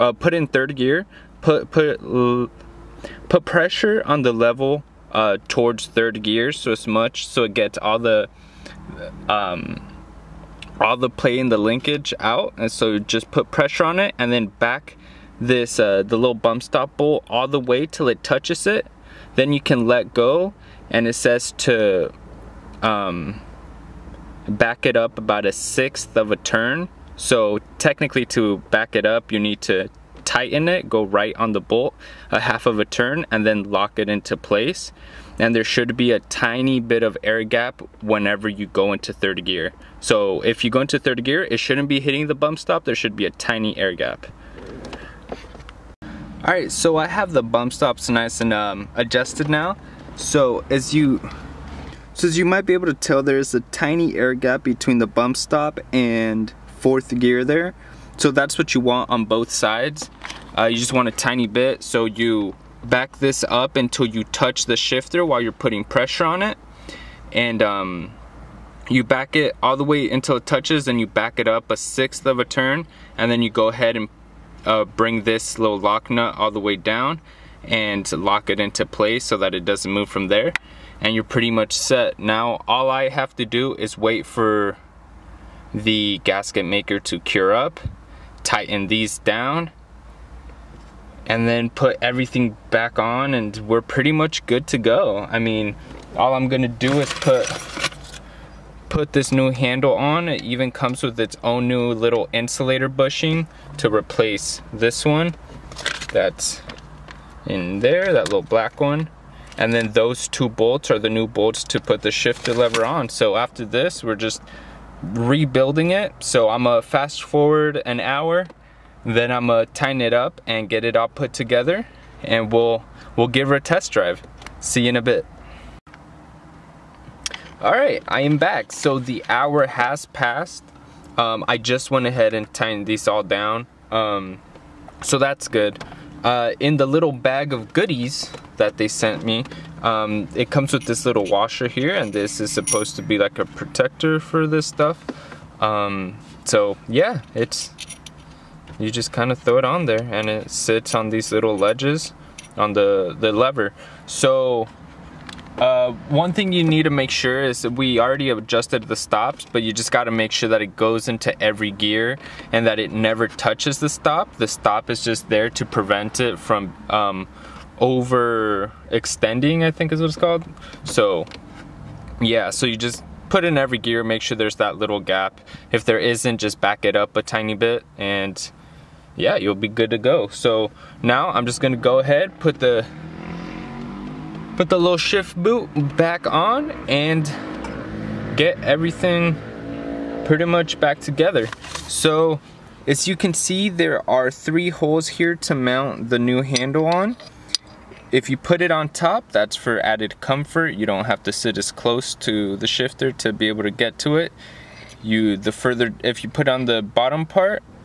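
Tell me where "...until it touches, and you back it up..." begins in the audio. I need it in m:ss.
1:10.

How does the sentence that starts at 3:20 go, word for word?
You don't have to sit as close to the shifter to be able to get to it.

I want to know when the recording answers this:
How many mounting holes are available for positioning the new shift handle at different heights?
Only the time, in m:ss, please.
3:14.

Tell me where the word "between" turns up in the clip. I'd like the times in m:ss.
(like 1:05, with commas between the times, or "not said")
0:54.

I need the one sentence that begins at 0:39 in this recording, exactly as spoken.
So if you go into third gear, it shouldn't be hitting the bump stop.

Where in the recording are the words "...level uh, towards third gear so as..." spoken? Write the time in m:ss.
0:04.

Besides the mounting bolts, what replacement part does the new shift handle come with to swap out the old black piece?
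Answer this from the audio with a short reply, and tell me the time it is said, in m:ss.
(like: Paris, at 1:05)
insulator bushing, at 1:42.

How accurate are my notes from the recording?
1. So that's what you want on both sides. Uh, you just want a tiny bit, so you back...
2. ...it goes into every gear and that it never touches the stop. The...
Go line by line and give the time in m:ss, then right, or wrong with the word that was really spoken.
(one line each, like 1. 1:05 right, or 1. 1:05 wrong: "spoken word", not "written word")
1. 0:58 right
2. 2:40 right.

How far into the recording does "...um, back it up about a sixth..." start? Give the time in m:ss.
0:22.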